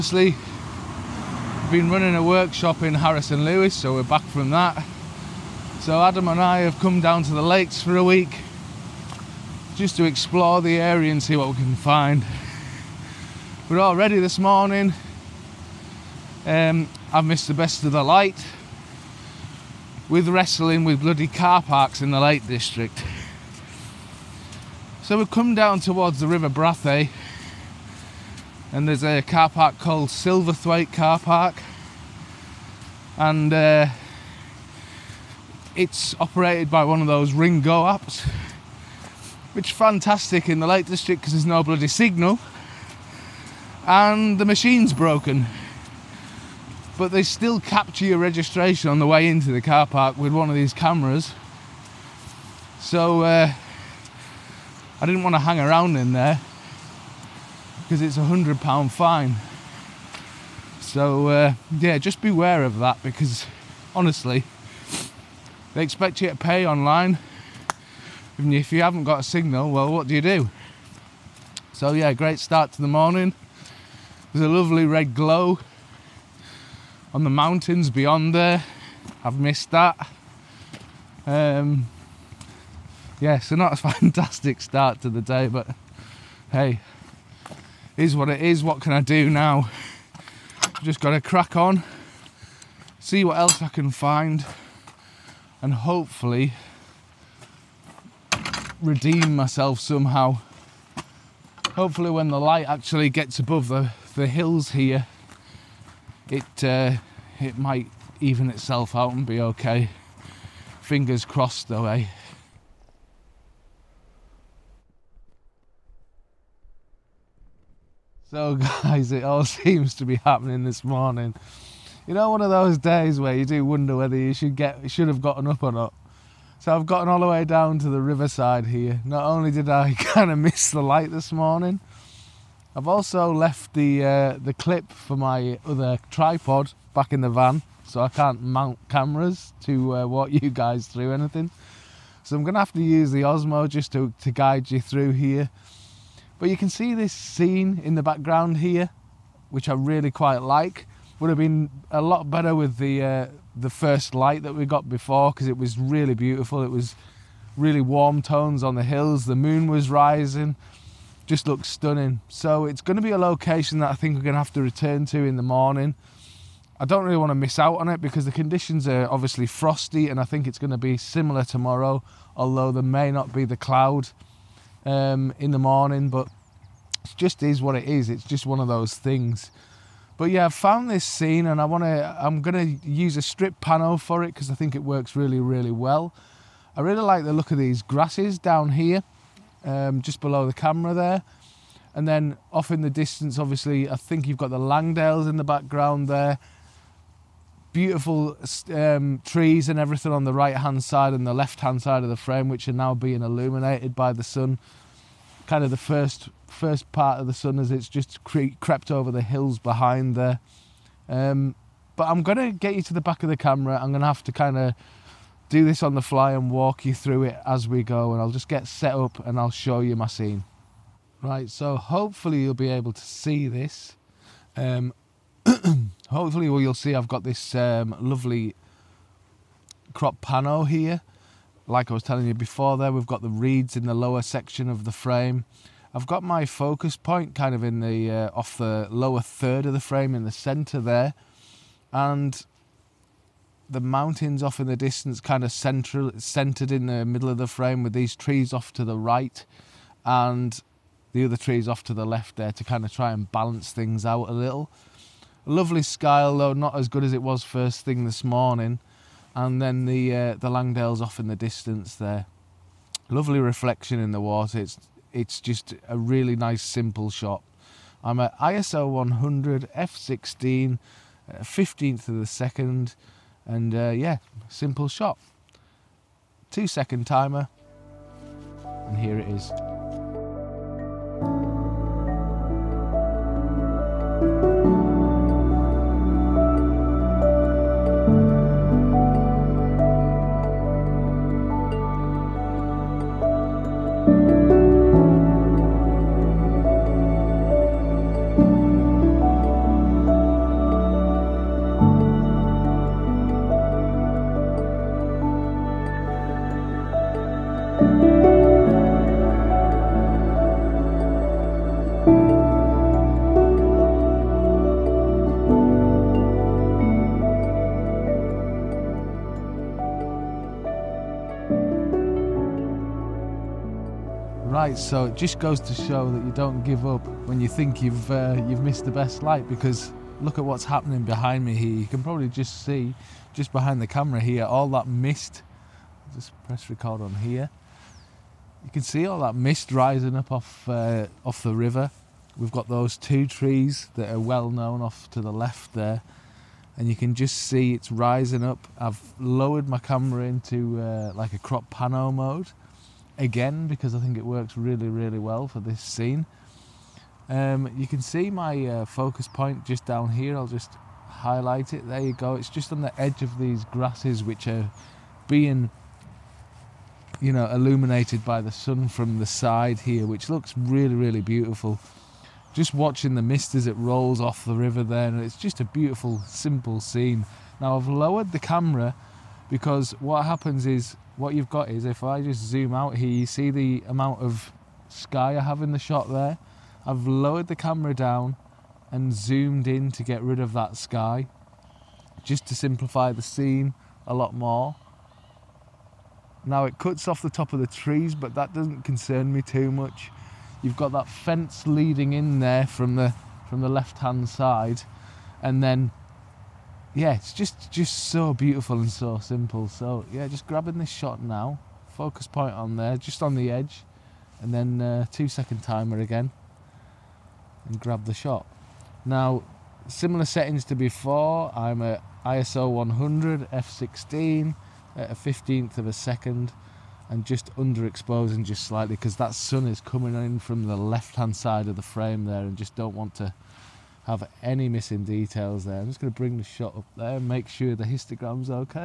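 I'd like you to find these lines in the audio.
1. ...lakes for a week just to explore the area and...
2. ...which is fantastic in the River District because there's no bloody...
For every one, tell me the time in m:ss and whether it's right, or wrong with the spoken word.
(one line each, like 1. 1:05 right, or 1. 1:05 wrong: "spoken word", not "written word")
1. 0:07 right
2. 0:39 wrong: "Lake", not "River".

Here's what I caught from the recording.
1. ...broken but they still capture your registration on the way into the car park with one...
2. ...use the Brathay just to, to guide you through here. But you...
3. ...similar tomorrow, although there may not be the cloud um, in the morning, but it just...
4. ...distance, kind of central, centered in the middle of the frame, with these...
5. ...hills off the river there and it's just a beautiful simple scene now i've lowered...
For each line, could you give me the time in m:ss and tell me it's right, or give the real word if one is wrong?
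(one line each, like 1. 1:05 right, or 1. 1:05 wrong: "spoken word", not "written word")
1. 0:44 right
2. 2:22 wrong: "Osmo", not "Brathay"
3. 2:50 right
4. 4:04 right
5. 6:13 wrong: "rolls", not "hills".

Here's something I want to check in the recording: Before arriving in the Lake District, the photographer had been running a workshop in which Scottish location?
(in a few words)
Harris and Lewis.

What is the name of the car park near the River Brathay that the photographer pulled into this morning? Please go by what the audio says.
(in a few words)
Silverthwaite Car Park.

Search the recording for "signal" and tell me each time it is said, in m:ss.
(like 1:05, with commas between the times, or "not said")
0:41, 1:09.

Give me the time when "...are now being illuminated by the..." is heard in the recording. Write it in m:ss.
3:22.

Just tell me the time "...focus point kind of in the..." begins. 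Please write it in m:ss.
3:56.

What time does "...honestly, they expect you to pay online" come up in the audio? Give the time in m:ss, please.
1:03.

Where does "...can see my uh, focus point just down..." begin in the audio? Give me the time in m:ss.
5:57.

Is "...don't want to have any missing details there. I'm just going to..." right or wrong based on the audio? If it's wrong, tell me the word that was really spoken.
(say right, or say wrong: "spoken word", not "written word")
right.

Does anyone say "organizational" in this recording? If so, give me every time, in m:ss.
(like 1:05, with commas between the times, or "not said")
not said.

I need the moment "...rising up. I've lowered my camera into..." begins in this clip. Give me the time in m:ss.
5:47.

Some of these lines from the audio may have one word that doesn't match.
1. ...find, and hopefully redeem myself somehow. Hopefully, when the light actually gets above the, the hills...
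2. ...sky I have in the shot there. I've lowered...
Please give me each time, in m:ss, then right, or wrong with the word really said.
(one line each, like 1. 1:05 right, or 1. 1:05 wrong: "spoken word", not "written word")
1. 1:33 right
2. 6:24 right.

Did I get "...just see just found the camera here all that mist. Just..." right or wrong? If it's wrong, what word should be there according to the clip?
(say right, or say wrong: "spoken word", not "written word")
wrong: "behind", not "found".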